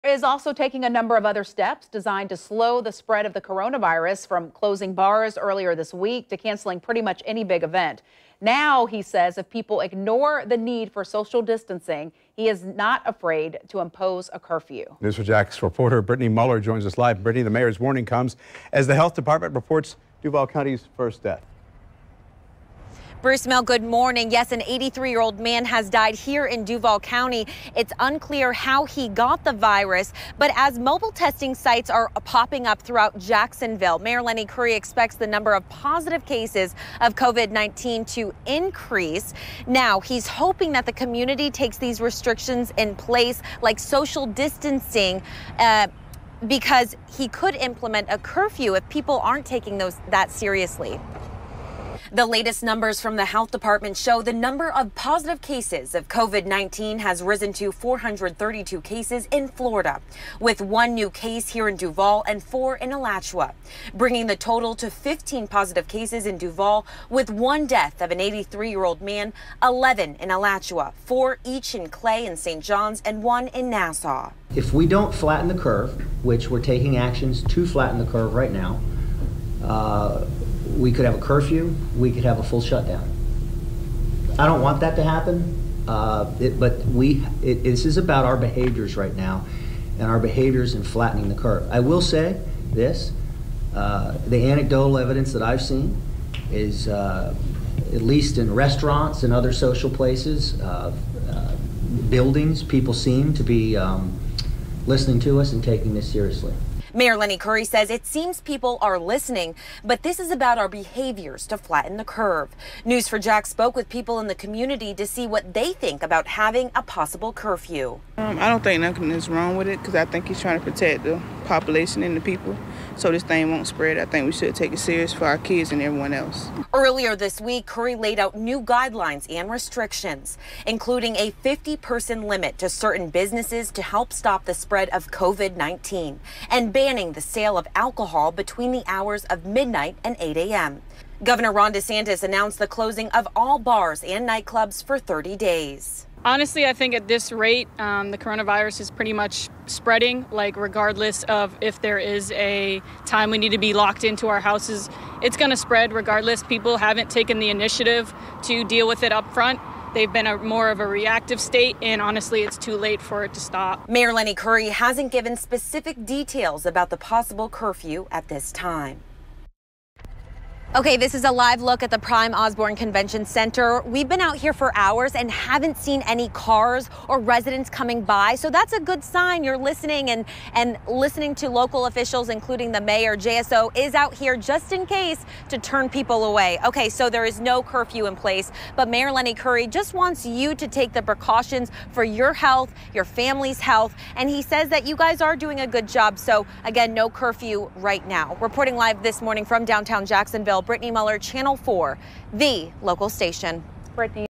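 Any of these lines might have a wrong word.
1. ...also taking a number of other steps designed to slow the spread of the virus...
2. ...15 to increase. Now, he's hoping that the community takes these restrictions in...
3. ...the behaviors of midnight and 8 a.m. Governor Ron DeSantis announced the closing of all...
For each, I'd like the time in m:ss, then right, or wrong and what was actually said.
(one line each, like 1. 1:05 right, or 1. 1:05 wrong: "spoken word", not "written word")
1. 0:00 wrong: "coronavirus", not "virus"
2. 0:37 wrong: "19", not "15"
3. 2:18 wrong: "hours", not "behaviors".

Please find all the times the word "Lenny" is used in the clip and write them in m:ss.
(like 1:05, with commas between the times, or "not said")
0:34, 1:47, 2:44, 3:09.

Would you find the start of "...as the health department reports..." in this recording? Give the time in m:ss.
0:18.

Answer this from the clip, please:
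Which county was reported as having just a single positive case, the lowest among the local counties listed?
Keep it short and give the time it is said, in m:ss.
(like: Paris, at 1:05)
Nassau, at 1:13.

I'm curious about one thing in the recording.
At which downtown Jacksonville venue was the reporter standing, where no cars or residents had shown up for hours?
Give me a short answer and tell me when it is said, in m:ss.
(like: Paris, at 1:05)
Prime Osborne Convention Center, at 2:51.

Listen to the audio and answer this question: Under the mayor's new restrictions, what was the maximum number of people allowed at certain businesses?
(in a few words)
50.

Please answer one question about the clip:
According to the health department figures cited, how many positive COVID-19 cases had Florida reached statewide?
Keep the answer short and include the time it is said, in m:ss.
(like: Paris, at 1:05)
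432, at 0:57.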